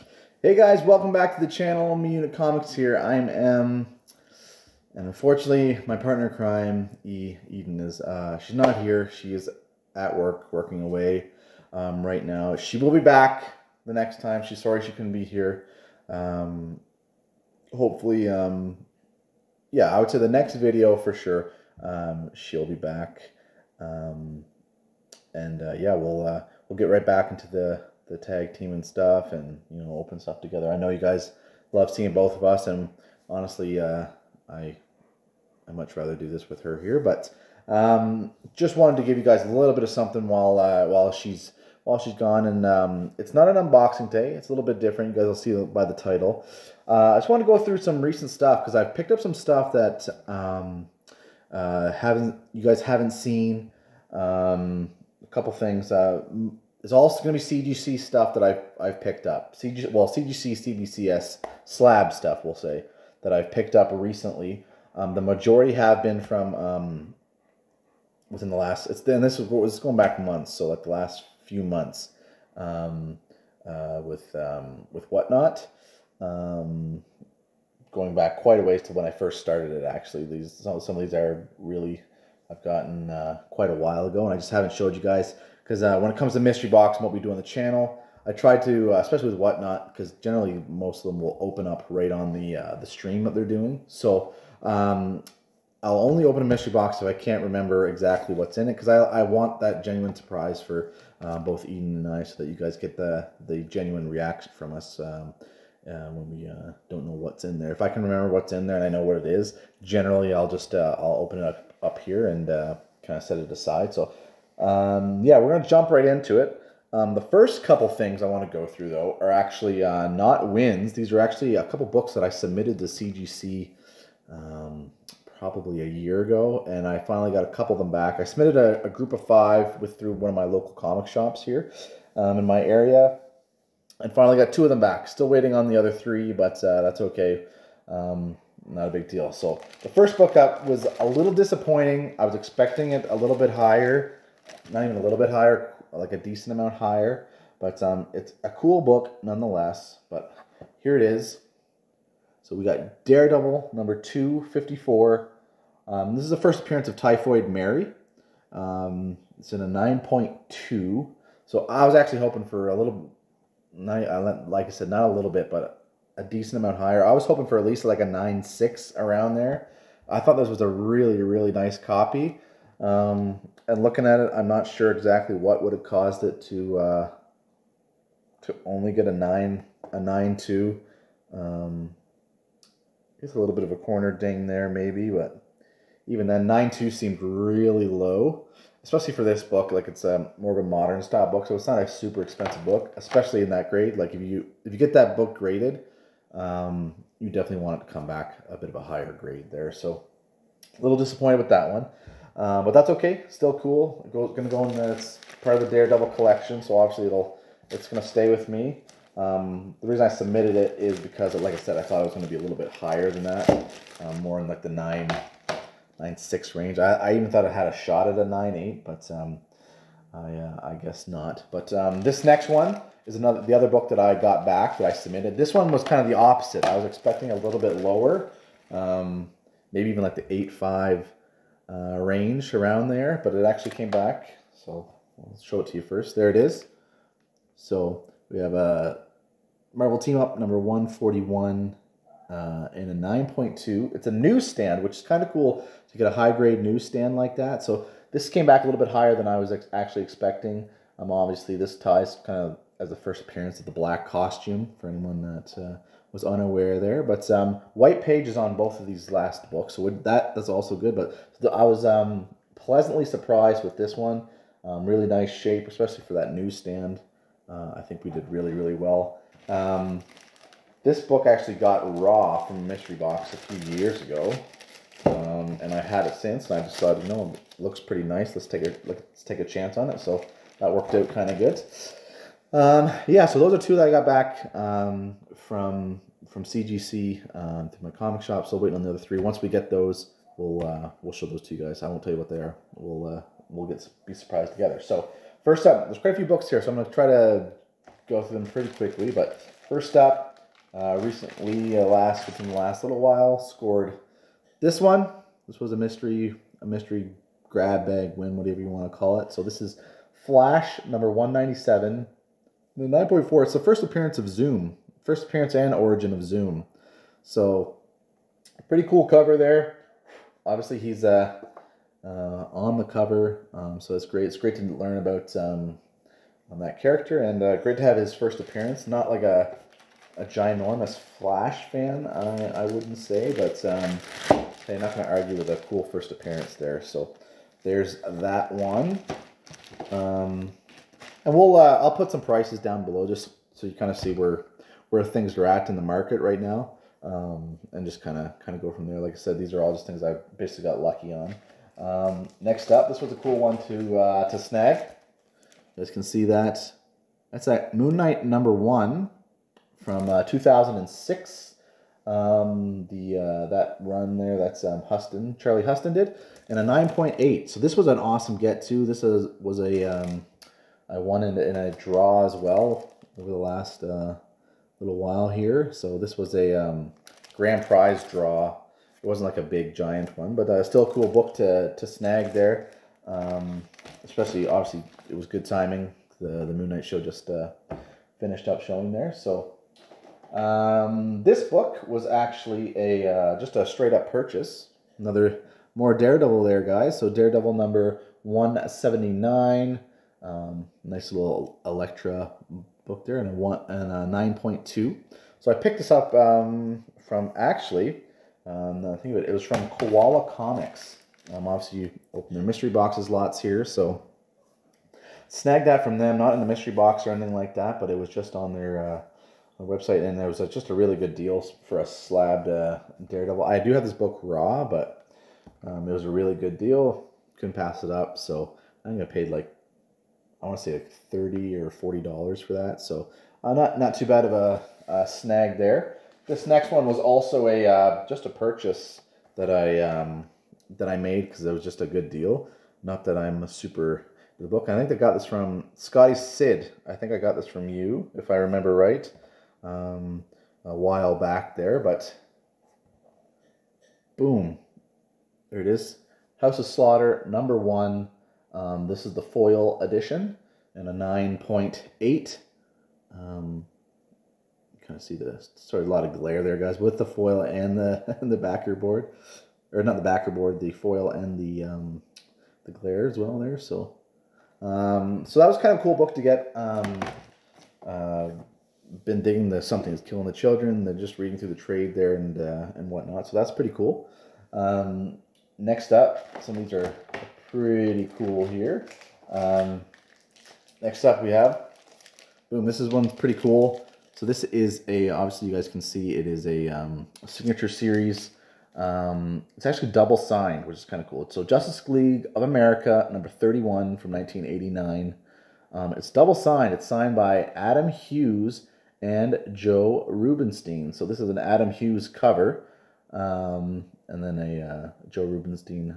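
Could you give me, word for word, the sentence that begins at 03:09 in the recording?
Like it's a um, more of a modern style book, so it's not a super expensive book, especially in that grade.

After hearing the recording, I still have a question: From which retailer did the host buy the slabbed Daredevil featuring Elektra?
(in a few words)
Koala Comics.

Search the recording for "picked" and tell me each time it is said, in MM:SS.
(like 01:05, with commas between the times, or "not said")
00:48, 00:59, 01:03, 06:45.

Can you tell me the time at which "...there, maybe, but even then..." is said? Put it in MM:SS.
03:04.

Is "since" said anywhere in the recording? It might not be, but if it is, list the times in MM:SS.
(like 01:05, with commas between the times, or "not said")
04:36.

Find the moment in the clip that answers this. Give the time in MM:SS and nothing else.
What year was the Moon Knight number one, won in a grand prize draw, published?
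06:00.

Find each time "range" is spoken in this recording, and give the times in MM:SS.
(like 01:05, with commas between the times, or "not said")
03:36, 03:51.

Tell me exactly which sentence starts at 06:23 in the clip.
Um, especially, obviously, it was good timing.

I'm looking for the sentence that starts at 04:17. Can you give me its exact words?
But um, White Page is on both of these last books, so that that's also good.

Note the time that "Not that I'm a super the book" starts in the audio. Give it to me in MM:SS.
07:22.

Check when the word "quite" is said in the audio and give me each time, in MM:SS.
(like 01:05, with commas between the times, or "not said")
01:18, 01:23, 04:55.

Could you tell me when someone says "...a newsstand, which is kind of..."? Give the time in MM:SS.
04:04.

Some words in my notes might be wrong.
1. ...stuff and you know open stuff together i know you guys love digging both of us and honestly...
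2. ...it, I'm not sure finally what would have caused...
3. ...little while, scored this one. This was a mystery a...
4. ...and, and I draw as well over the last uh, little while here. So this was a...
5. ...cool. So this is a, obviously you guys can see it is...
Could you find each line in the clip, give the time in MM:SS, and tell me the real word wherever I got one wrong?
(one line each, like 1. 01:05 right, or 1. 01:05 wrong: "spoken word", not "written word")
1. 00:28 wrong: "seeing", not "digging"
2. 02:54 wrong: "exactly", not "finally"
3. 05:02 right
4. 06:11 right
5. 08:13 right.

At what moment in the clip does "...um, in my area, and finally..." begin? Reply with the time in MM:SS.
02:12.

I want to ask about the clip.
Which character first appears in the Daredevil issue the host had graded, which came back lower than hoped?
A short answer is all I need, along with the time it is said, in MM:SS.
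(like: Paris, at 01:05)
Typhoid Mary, at 02:36.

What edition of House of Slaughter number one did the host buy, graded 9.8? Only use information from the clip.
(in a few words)
foil edition.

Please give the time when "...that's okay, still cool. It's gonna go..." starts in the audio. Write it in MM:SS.
03:22.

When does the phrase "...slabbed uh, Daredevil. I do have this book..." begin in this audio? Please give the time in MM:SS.
07:01.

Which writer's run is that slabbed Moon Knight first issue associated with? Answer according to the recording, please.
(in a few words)
Charlie Huston.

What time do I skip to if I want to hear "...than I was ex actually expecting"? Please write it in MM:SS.
04:09.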